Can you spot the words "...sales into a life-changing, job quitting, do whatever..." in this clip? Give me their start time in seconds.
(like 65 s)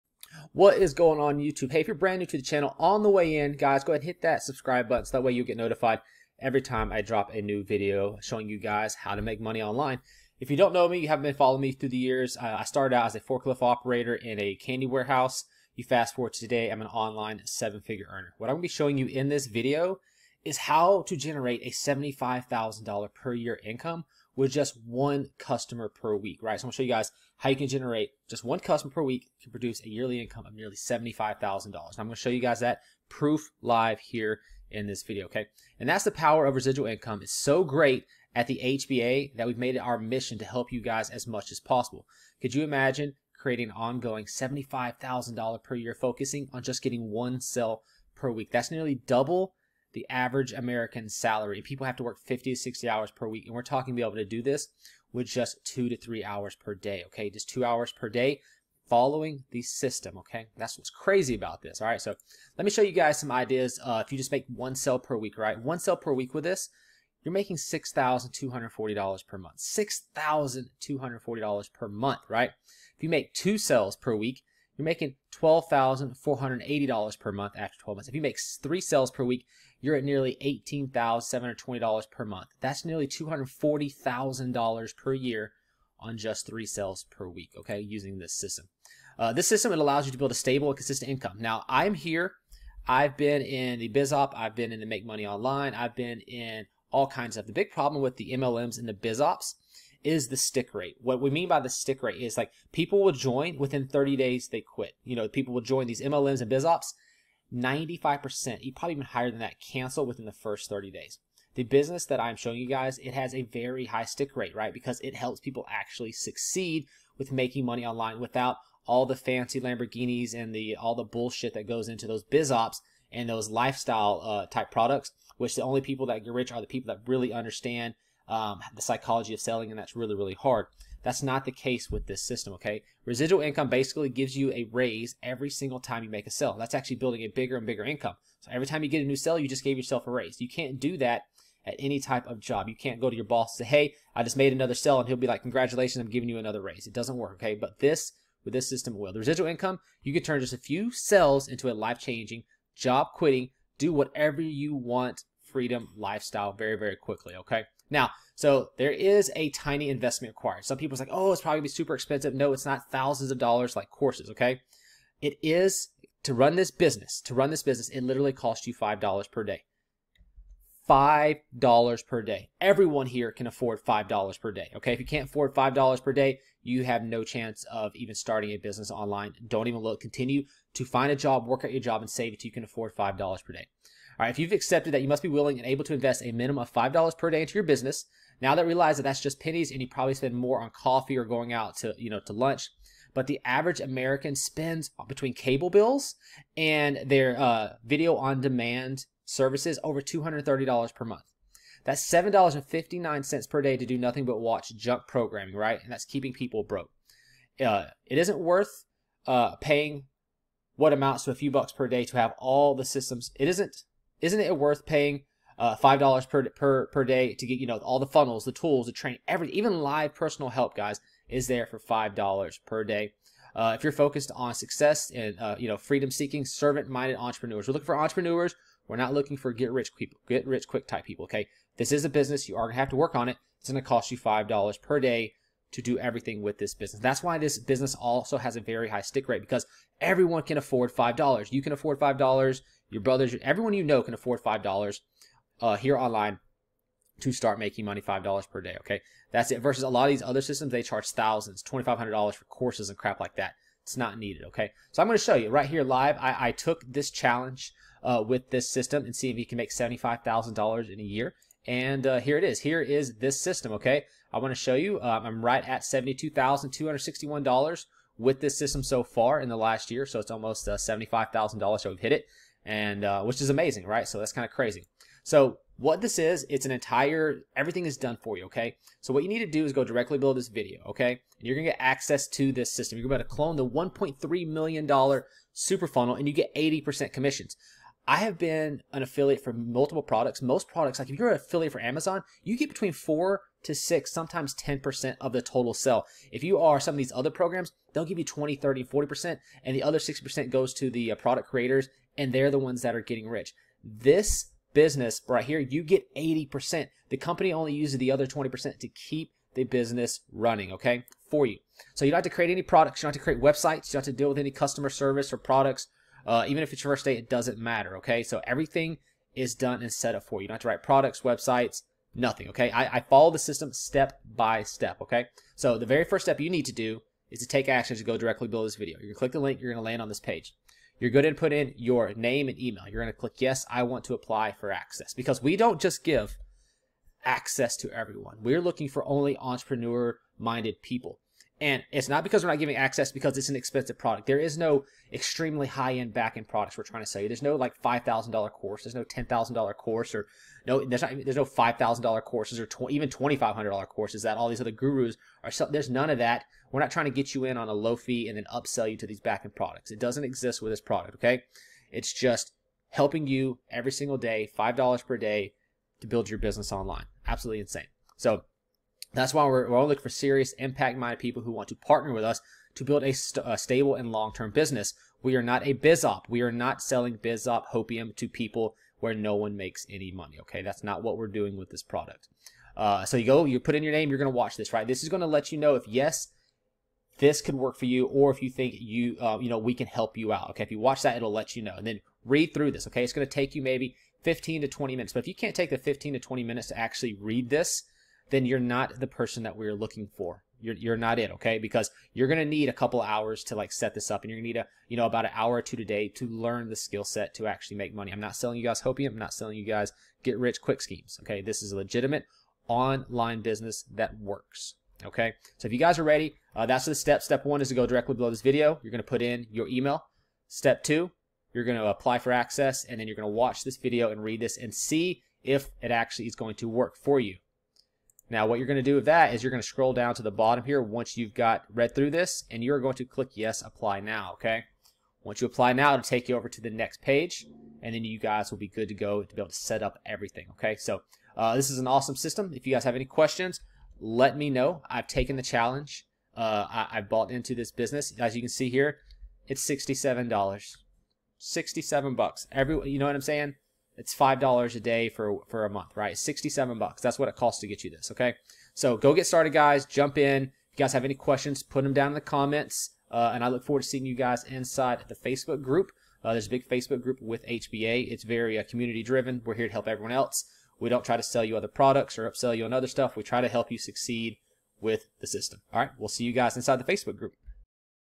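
150 s.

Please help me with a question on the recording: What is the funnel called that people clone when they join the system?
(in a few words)
$1.3 million super funnel.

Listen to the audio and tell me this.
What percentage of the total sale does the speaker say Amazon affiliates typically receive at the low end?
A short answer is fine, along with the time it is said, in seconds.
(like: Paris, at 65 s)
4 to 6%, at 292 s.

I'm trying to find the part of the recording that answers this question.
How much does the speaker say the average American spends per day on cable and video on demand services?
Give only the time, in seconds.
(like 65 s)
202 s.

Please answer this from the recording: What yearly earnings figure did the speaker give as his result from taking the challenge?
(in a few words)
$72,261.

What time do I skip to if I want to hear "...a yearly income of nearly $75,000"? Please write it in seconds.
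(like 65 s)
29 s.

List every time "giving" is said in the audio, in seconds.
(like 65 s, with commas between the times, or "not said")
146 s, 342 s.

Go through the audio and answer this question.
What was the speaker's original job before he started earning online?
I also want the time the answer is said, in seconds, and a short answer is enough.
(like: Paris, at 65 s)
Forklift operator in a candy warehouse, at 13 s.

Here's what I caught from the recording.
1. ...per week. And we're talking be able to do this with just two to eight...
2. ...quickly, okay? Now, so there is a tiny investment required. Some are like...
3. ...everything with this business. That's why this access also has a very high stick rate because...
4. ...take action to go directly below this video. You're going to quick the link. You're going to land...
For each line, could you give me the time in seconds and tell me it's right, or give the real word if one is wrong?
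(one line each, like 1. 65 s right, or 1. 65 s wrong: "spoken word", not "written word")
1. 53 s wrong: "three", not "eight"
2. 156 s right
3. 235 s wrong: "business", not "access"
4. 327 s wrong: "click", not "quick".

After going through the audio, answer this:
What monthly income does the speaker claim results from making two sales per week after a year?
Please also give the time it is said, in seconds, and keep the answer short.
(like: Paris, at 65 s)
$12,480, at 75 s.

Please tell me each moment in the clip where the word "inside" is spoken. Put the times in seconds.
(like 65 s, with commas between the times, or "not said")
464 s, 476 s.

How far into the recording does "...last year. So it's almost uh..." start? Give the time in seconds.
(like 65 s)
269 s.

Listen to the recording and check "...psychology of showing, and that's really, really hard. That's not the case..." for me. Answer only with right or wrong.
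wrong.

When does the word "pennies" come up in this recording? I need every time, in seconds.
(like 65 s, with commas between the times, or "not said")
189 s.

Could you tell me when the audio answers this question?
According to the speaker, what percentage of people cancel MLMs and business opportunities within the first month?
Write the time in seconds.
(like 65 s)
107 s.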